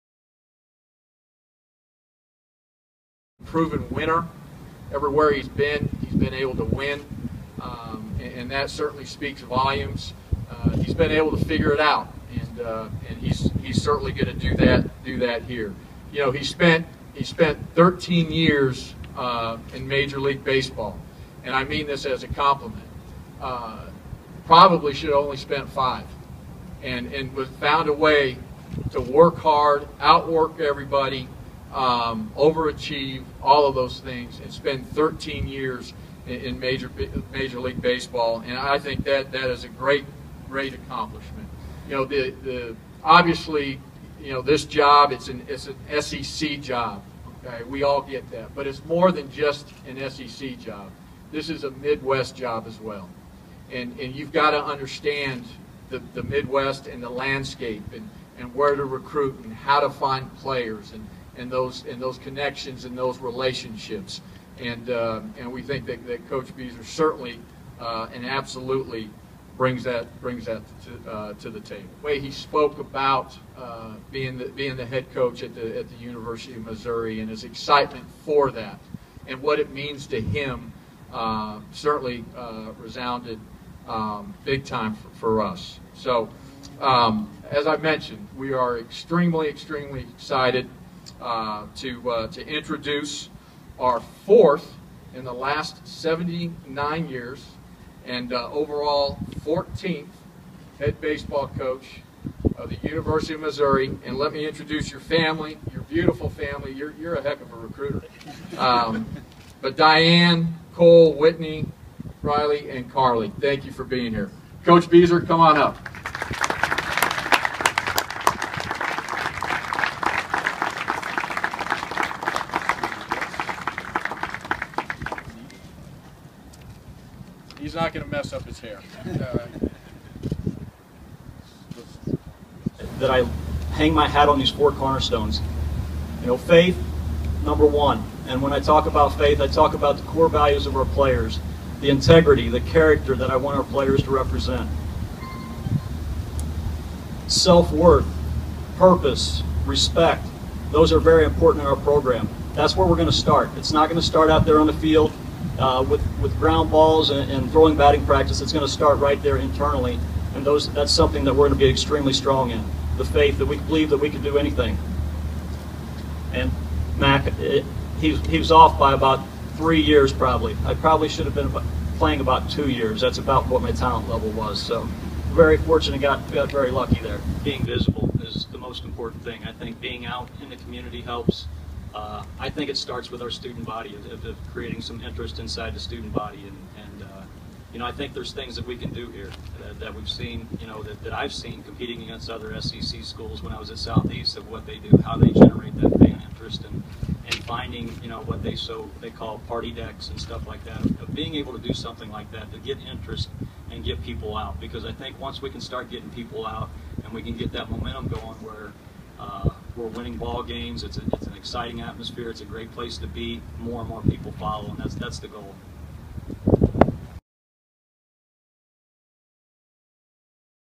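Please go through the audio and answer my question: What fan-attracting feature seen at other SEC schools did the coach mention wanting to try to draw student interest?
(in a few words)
party decks.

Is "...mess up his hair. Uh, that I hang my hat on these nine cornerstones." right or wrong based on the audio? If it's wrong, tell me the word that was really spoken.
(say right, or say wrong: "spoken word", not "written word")
wrong: "four", not "nine".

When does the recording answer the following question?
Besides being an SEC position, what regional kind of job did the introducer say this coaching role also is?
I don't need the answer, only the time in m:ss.
0:51.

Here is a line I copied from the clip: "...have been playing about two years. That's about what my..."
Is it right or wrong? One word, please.
right.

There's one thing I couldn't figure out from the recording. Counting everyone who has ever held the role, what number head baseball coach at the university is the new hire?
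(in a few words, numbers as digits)
14th.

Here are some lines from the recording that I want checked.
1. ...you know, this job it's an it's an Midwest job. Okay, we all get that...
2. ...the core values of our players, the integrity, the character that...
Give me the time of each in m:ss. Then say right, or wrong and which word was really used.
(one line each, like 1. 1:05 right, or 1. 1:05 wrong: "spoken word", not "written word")
1. 0:44 wrong: "SEC", not "Midwest"
2. 2:19 right.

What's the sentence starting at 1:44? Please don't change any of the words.
And let me introduce your family, your beautiful family.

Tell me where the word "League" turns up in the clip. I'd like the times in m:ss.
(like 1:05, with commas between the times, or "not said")
0:20, 0:37.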